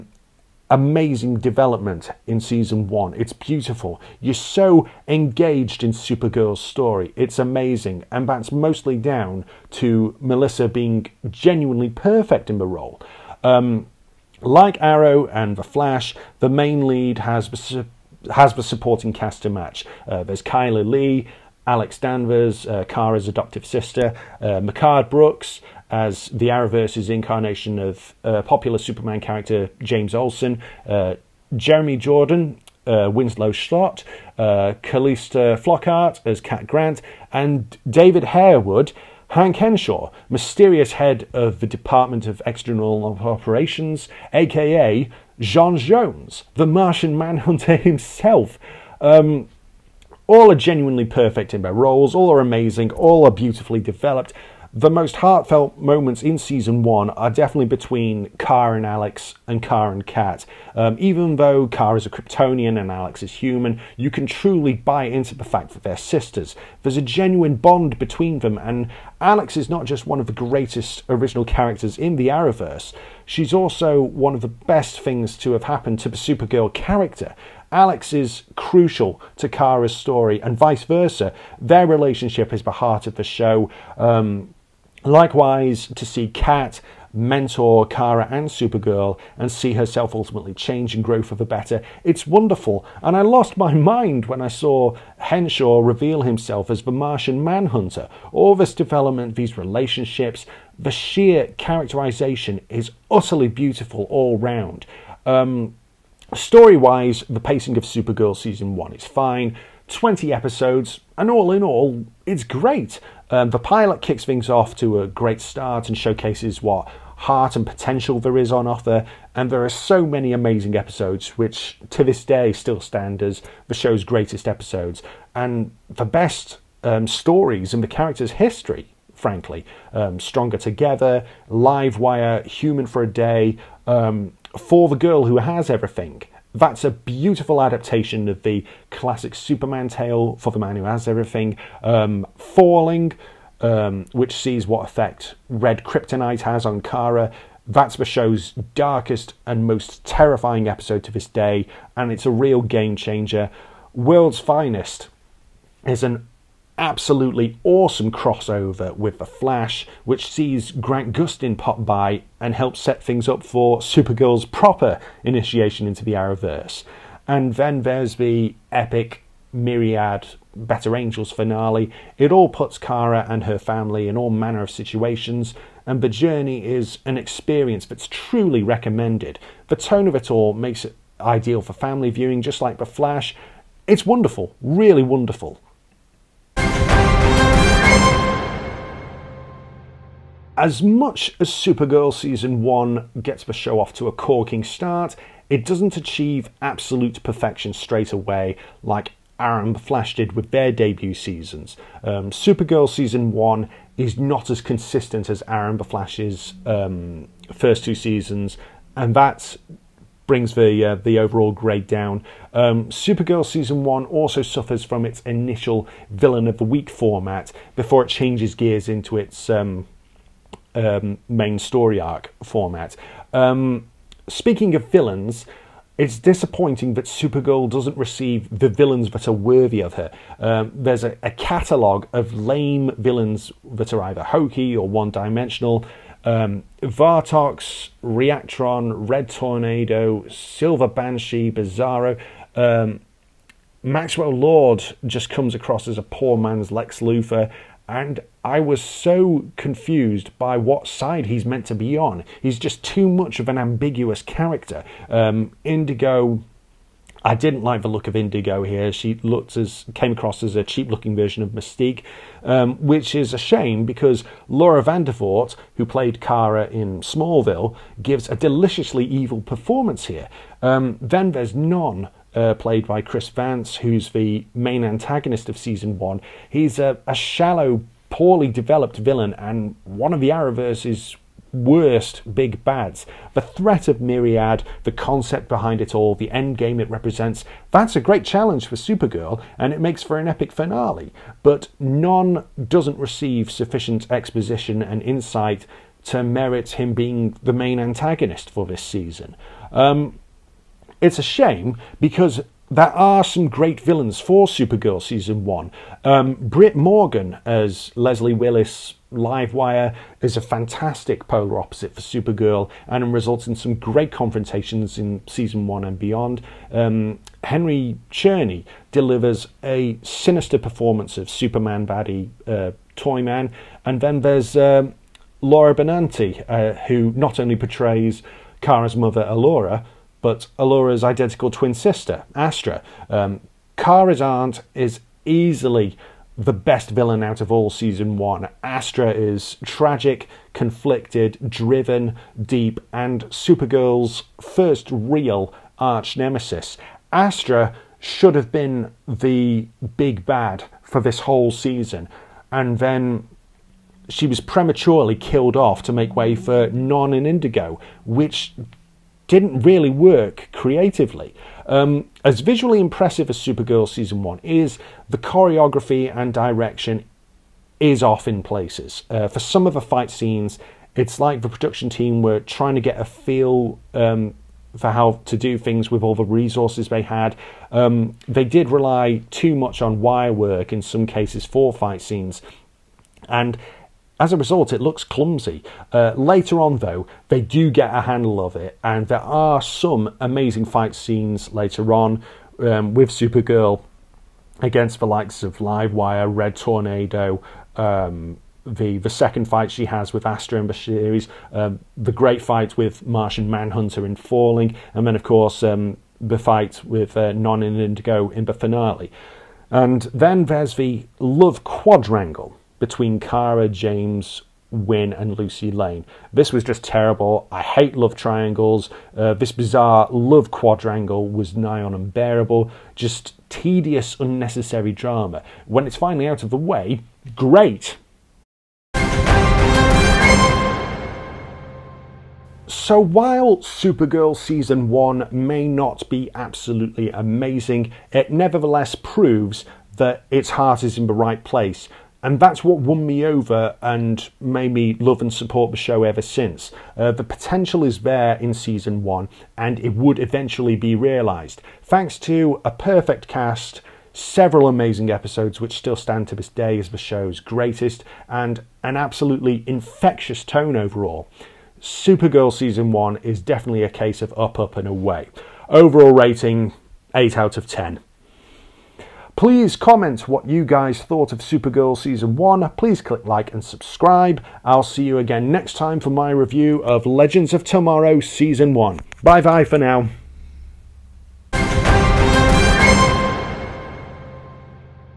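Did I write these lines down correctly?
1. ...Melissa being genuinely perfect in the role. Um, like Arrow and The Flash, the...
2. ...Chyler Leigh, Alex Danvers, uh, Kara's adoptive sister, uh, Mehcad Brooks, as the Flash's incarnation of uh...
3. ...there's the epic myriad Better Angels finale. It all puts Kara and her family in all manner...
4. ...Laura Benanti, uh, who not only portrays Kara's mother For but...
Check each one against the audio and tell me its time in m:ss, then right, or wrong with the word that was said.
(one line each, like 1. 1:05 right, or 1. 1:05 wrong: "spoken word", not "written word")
1. 0:10 right
2. 0:20 wrong: "Arrowverse", not "Flash"
3. 2:47 right
4. 5:25 wrong: "Alura", not "For".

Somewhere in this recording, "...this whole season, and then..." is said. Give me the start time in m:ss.
5:51.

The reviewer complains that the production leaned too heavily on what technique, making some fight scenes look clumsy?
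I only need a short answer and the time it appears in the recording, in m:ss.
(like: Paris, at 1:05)
Wire work, at 6:20.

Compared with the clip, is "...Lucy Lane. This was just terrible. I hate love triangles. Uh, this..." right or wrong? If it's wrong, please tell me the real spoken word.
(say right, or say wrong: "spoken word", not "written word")
right.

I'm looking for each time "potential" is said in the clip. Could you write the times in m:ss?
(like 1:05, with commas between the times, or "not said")
1:57, 7:27.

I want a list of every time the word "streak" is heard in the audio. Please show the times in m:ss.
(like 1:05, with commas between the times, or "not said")
not said.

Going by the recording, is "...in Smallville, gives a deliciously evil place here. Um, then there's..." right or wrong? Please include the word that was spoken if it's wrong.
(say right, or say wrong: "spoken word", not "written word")
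wrong: "performance", not "place".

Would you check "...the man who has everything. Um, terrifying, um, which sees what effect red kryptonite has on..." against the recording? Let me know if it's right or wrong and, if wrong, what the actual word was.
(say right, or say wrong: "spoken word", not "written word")
wrong: "falling", not "terrifying".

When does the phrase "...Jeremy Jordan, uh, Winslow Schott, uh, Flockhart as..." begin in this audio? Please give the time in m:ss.
0:31.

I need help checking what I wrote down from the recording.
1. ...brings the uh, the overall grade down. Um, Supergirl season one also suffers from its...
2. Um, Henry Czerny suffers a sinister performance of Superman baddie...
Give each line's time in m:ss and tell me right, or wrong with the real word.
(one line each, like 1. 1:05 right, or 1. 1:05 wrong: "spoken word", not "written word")
1. 3:30 right
2. 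5:16 wrong: "delivers", not "suffers".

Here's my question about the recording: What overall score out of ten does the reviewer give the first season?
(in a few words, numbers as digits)
8.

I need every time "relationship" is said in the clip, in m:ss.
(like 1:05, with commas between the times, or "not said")
1:21, 1:39.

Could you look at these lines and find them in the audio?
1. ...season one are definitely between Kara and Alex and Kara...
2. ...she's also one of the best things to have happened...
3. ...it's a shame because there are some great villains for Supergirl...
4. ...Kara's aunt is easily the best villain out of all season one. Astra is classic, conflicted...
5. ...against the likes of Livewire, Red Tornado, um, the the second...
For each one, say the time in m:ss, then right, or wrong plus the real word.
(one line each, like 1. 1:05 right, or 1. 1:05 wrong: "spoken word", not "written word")
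1. 0:56 right
2. 1:13 right
3. 5:01 right
4. 5:33 wrong: "tragic", not "classic"
5. 6:34 right.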